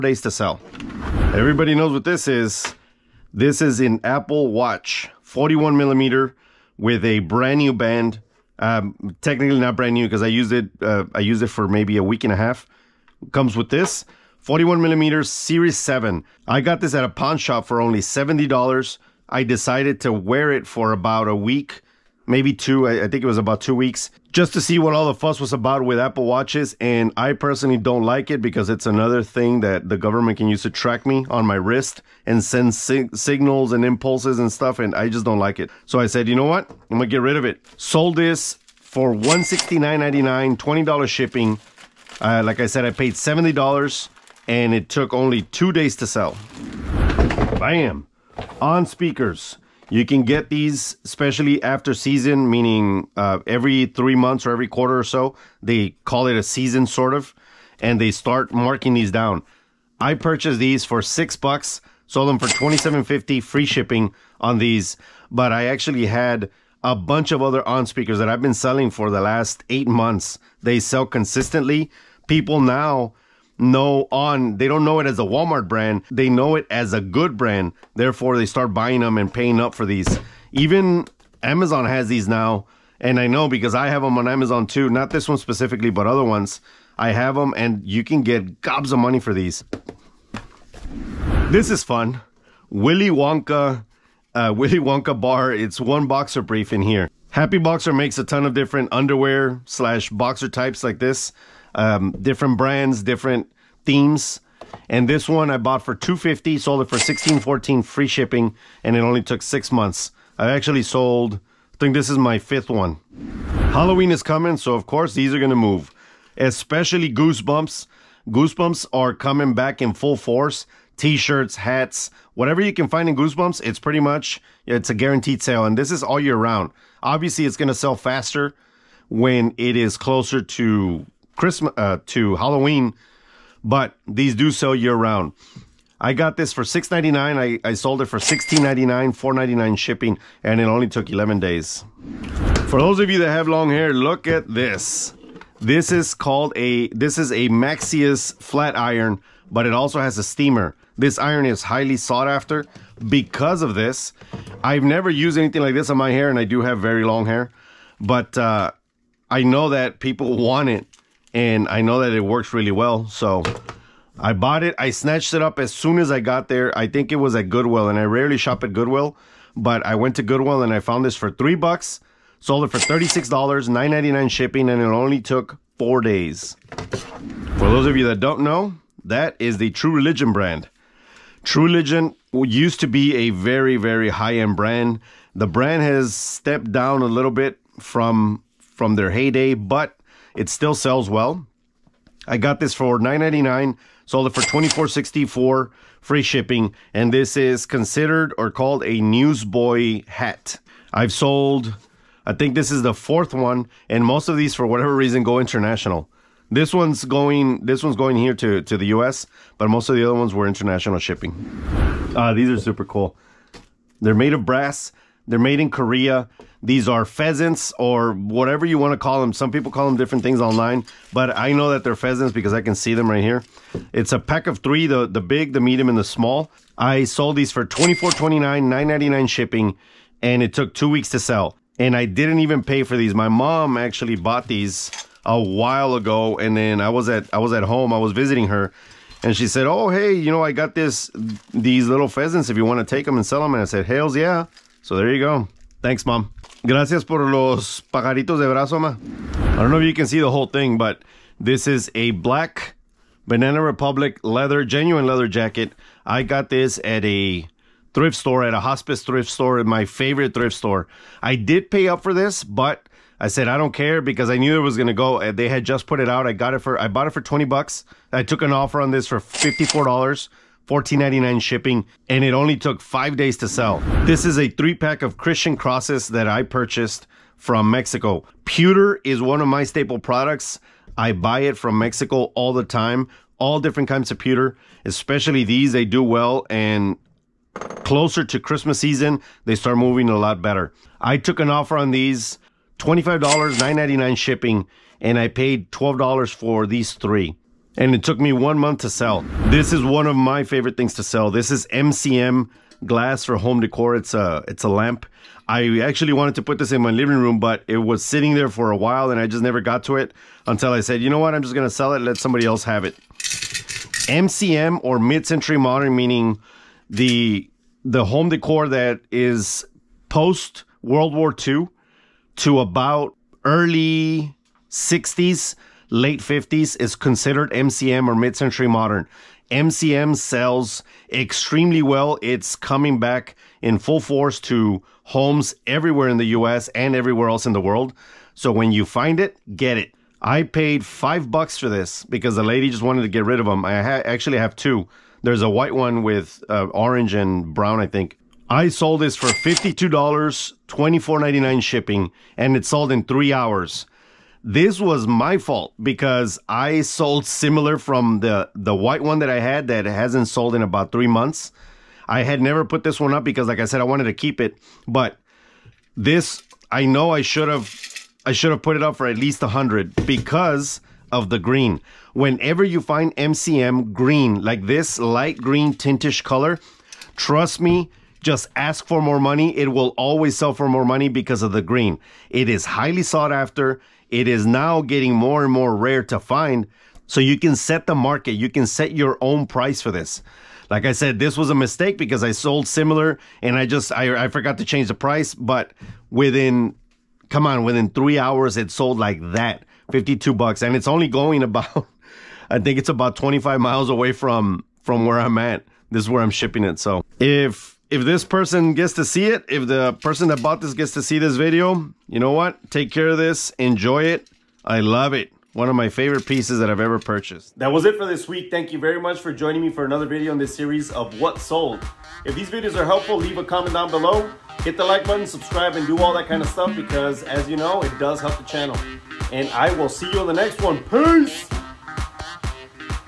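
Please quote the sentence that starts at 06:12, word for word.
Whenever you find MCM green, like this light green tintish color, trust me, just ask for more money.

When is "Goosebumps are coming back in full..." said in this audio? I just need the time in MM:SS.
01:58.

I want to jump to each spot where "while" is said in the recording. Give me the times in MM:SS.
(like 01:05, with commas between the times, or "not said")
03:55, 05:08.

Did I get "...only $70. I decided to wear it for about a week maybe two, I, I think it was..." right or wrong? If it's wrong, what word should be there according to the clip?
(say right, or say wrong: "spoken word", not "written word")
right.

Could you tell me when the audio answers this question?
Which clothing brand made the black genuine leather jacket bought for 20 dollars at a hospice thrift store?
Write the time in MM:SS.
04:13.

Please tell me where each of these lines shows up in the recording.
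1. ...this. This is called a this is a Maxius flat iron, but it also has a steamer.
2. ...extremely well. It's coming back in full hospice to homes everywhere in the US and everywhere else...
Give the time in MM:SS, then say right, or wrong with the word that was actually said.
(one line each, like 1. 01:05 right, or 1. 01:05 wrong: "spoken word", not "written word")
1. 02:24 right
2. 05:31 wrong: "force", not "hospice".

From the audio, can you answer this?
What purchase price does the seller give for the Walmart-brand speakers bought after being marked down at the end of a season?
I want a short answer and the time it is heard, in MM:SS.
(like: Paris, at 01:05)
$6, at 01:01.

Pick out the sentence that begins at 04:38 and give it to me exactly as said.
Pewter is one of my staple products.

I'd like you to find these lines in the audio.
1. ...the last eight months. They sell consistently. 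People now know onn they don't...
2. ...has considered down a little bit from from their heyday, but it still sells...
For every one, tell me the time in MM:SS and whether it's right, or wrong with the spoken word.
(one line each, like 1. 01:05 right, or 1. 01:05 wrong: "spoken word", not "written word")
1. 01:09 right
2. 03:05 wrong: "stepped", not "considered".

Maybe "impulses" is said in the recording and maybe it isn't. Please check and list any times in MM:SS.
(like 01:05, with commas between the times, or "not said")
00:33.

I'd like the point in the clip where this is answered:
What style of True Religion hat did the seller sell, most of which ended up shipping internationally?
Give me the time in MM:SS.
03:19.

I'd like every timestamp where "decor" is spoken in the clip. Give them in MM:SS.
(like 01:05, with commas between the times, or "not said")
05:03, 05:18.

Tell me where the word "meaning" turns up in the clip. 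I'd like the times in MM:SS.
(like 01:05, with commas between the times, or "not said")
00:52, 05:15.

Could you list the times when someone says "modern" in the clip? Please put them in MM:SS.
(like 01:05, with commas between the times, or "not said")
05:15, 05:28.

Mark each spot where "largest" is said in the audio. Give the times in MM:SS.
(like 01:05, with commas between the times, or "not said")
not said.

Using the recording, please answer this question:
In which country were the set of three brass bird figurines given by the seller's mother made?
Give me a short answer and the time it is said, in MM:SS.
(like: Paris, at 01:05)
Korea, at 03:35.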